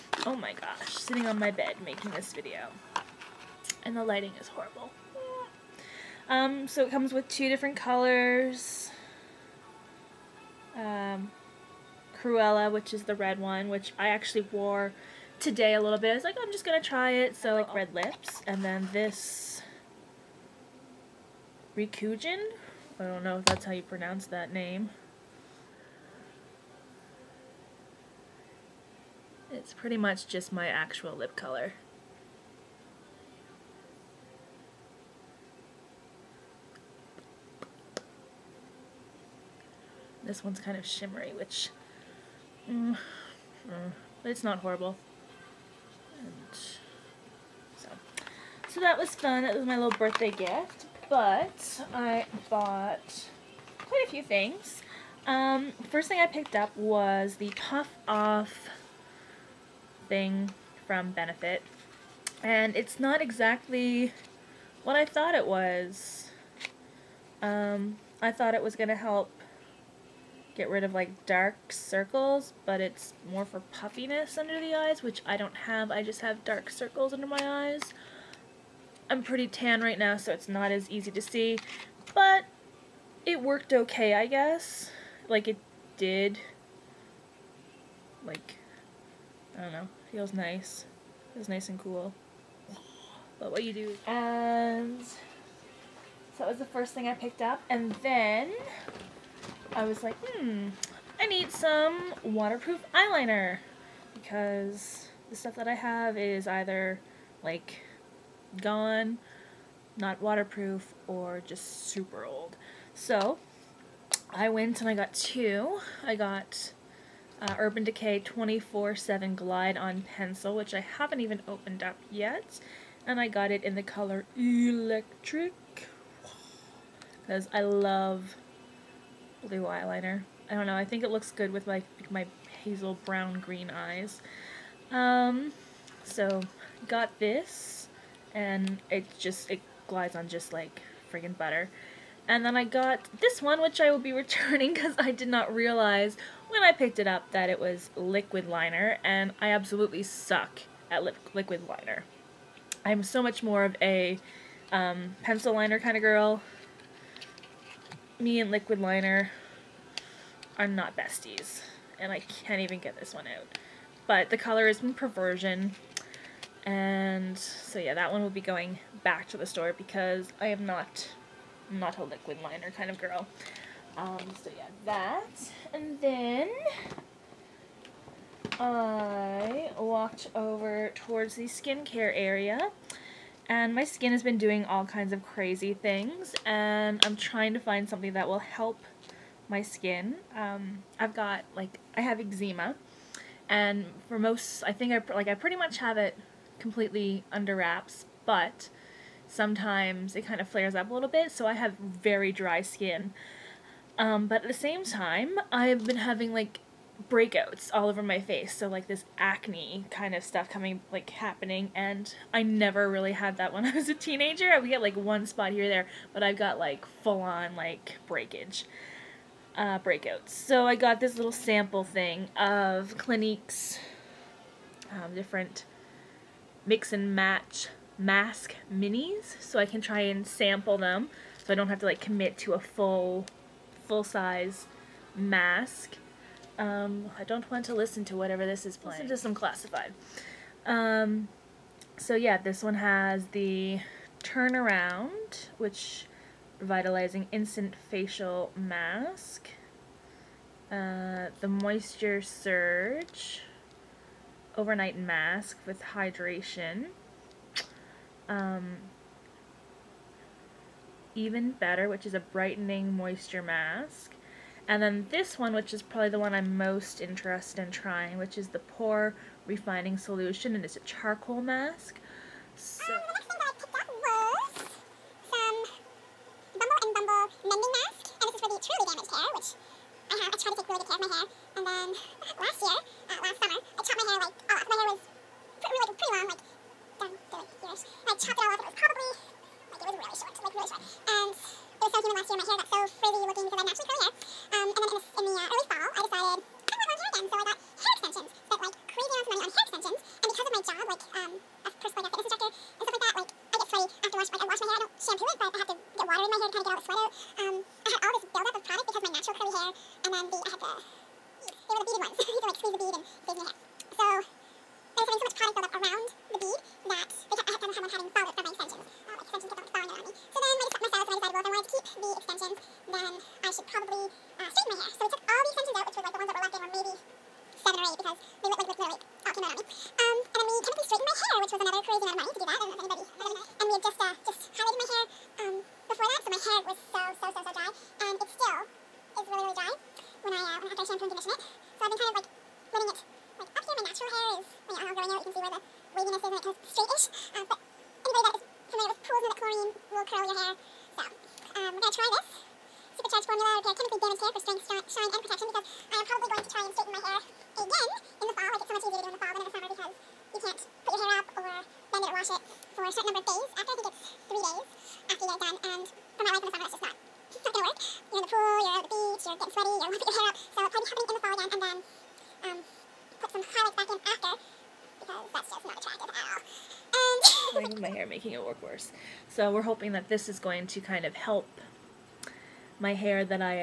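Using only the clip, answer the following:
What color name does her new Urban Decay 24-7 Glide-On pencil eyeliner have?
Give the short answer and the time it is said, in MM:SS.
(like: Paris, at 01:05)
Electric, at 02:04.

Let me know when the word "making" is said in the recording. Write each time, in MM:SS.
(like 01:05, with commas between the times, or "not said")
00:01, 06:18.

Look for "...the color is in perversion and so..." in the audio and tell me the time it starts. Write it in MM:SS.
02:44.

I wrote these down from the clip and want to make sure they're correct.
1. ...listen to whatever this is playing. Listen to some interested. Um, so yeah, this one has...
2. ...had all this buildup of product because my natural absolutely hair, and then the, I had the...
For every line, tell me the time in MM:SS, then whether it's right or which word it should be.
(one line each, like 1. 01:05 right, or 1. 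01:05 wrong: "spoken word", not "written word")
1. 03:57 wrong: "classified", not "interested"
2. 05:07 wrong: "curly", not "absolutely".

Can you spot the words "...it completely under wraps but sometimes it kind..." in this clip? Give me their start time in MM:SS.
03:15.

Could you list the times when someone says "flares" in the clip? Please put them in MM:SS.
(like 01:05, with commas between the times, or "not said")
03:20.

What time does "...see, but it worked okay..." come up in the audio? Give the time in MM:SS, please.
01:21.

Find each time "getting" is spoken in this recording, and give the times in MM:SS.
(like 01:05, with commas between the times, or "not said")
06:09.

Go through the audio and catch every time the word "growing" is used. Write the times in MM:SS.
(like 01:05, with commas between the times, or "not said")
not said.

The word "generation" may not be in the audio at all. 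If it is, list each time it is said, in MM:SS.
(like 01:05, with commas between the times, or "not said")
not said.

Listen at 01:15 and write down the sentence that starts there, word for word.
I just have dark circles under my eyes.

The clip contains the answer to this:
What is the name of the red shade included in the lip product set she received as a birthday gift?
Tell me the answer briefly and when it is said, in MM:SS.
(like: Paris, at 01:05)
Cruella, at 00:12.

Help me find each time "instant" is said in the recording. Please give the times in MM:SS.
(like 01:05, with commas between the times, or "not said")
04:07.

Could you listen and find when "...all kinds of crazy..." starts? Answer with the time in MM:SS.
03:04.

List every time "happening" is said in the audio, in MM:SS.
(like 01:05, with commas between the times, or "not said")
03:31, 06:10.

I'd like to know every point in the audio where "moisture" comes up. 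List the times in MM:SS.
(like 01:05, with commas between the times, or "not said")
04:11, 04:22.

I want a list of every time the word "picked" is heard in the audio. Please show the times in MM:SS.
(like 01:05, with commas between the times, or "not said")
00:56, 01:37, 02:26.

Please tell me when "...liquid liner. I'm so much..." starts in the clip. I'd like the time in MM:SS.
02:31.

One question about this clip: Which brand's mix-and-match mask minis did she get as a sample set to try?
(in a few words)
Clinique.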